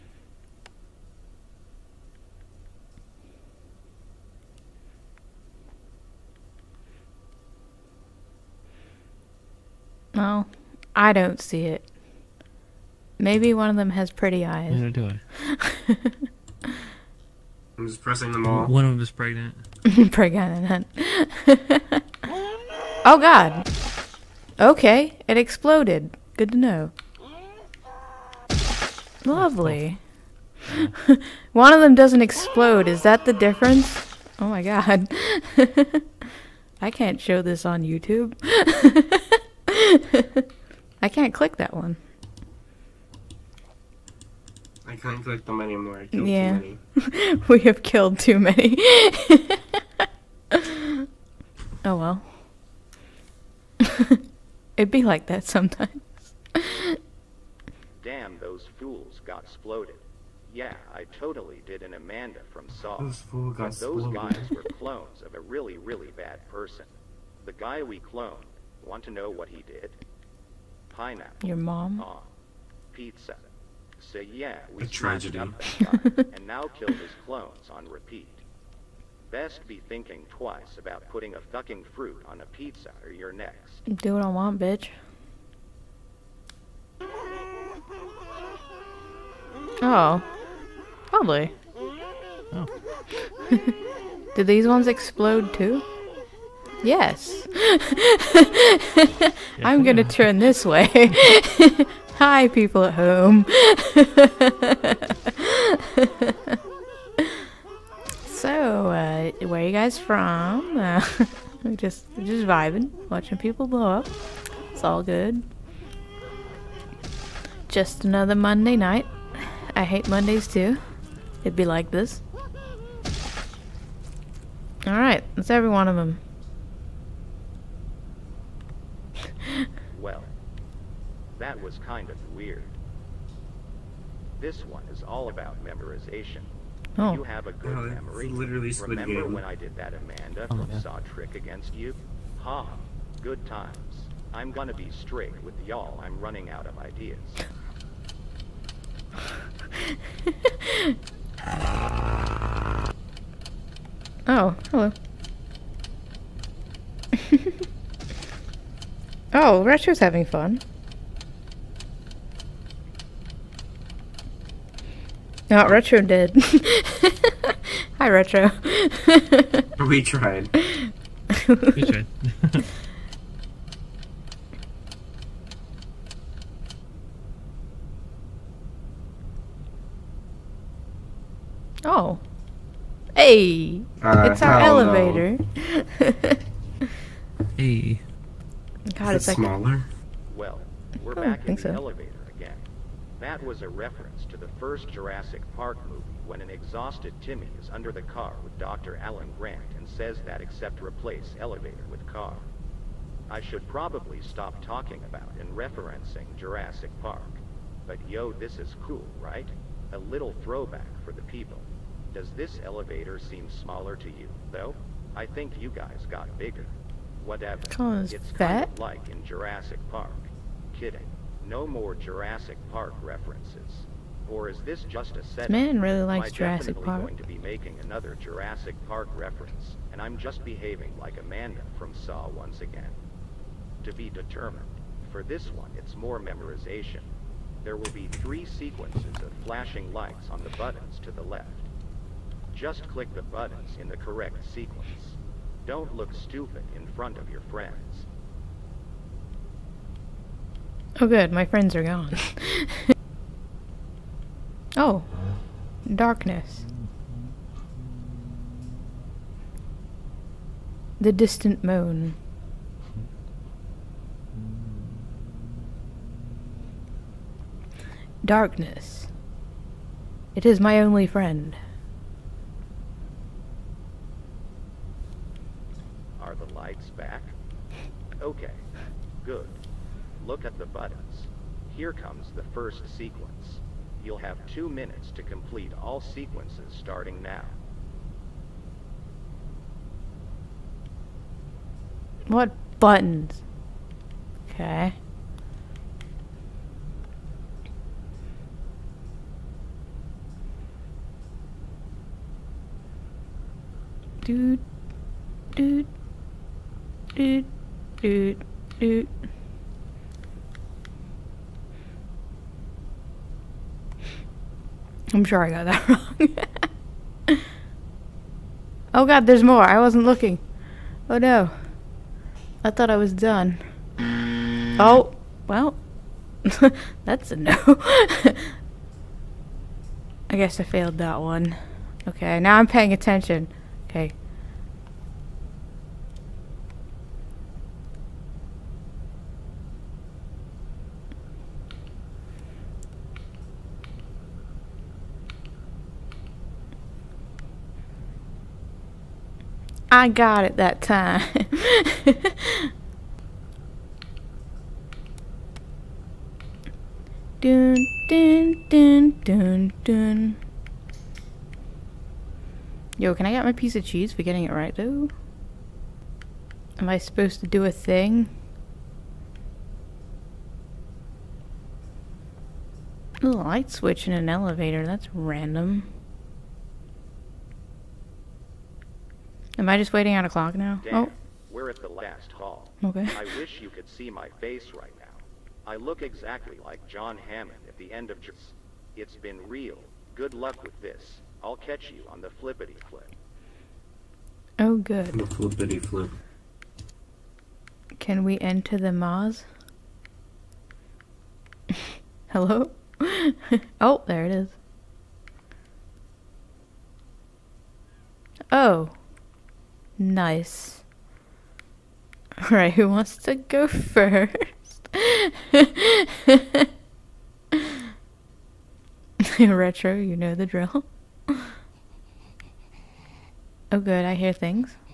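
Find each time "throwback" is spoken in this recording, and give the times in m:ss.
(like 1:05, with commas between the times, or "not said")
3:30.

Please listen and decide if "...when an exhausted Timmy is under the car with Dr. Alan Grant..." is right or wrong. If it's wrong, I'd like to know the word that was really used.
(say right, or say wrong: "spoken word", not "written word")
right.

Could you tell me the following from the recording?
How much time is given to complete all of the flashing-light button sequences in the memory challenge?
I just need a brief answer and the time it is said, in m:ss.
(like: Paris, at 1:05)
2 minutes, at 4:44.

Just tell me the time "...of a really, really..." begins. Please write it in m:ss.
1:05.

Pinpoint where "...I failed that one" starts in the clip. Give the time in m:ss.
5:30.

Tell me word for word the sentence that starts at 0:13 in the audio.
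Maybe one of them has pretty eyes.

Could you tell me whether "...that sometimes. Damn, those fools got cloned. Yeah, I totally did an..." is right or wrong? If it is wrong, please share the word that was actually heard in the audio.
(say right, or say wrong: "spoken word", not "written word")
wrong: "exploded", not "cloned".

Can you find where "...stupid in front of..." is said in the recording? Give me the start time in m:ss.
4:06.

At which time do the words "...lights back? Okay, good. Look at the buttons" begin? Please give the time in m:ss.
4:36.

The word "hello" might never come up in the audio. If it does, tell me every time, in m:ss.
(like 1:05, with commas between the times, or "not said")
2:34, 6:42.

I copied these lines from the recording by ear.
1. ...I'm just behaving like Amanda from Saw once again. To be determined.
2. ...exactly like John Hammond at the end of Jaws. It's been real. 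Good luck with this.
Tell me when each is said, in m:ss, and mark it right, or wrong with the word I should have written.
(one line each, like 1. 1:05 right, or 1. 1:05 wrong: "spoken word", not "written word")
1. 3:50 right
2. 6:26 right.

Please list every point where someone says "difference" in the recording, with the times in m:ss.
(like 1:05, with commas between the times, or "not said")
0:33.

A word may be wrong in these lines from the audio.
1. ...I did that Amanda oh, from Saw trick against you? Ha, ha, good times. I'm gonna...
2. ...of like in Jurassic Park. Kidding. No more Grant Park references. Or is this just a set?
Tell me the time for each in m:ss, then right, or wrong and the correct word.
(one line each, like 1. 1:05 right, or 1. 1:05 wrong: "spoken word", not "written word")
1. 2:19 right
2. 3:38 wrong: "Jurassic", not "Grant".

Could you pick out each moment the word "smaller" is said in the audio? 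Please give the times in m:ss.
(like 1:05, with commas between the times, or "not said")
3:09, 3:33.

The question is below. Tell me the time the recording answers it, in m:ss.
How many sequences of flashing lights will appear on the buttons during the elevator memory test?
3:58.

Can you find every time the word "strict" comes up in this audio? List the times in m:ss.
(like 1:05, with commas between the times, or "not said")
2:24.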